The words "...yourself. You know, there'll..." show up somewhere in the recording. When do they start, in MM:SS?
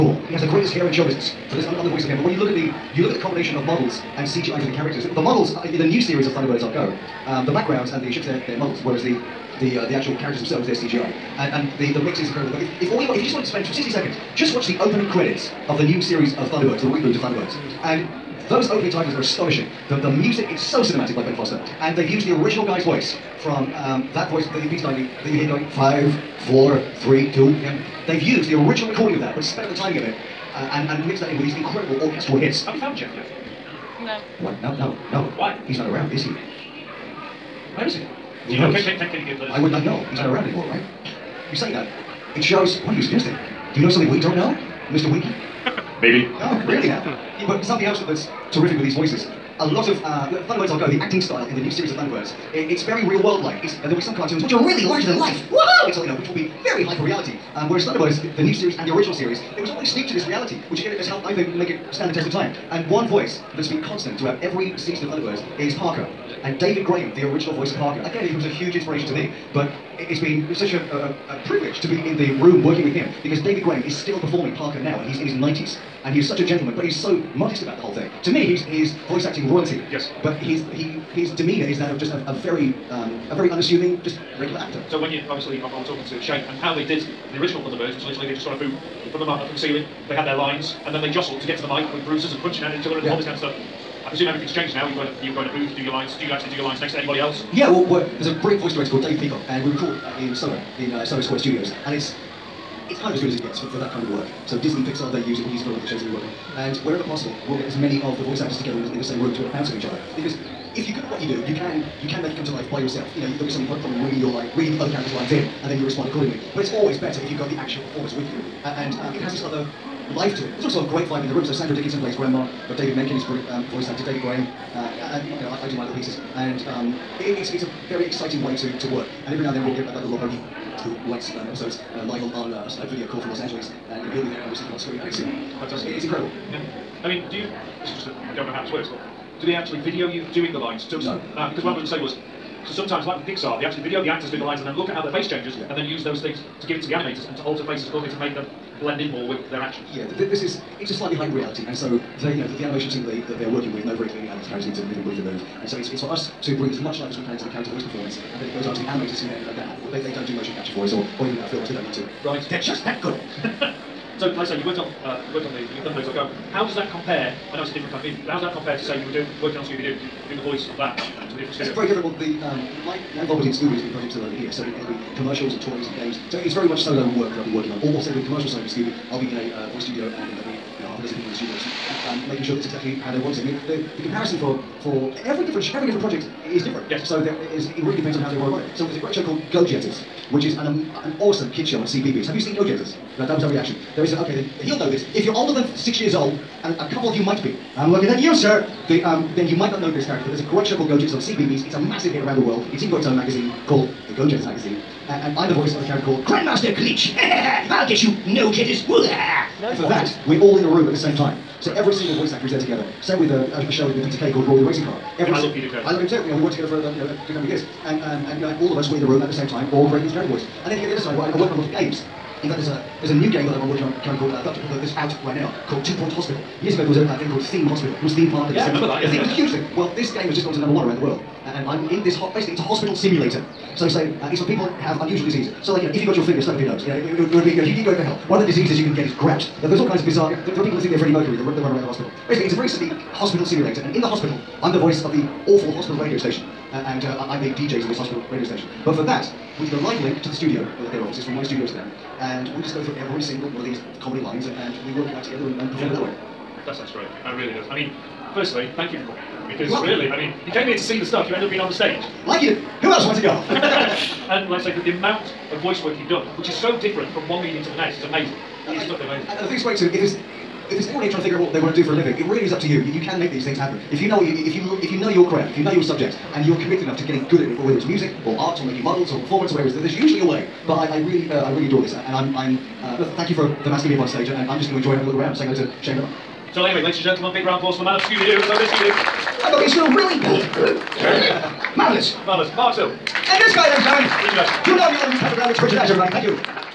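01:52.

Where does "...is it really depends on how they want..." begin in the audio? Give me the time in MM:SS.
03:07.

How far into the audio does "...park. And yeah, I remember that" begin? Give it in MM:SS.
03:48.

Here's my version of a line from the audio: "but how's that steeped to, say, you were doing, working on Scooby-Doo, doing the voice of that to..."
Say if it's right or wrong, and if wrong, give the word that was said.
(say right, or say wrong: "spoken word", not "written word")
wrong: "compared", not "steeped".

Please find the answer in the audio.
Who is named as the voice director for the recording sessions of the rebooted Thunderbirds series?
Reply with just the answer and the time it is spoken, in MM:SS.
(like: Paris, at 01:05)
Dave Peacock, at 01:39.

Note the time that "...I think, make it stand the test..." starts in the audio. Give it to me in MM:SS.
01:01.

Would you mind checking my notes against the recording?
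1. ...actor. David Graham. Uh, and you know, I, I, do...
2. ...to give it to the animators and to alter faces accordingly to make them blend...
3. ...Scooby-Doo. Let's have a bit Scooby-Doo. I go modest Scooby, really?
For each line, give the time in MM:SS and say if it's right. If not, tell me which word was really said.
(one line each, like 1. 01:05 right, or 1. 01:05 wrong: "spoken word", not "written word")
1. 02:03 right
2. 02:26 right
3. 04:48 wrong: "against", not "modest".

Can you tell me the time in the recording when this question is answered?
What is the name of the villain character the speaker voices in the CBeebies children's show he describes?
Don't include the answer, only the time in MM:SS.
03:26.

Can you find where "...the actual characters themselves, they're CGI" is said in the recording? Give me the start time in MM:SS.
00:09.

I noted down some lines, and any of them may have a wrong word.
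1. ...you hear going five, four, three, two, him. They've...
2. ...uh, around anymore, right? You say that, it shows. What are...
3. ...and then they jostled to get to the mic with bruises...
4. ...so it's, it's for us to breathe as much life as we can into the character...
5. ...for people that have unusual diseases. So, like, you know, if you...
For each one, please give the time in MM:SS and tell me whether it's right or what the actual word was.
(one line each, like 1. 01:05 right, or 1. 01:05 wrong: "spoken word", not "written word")
1. 00:25 right
2. 00:40 right
3. 01:30 right
4. 02:35 right
5. 03:54 right.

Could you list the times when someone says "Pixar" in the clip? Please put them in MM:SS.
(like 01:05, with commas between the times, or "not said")
01:44, 02:23.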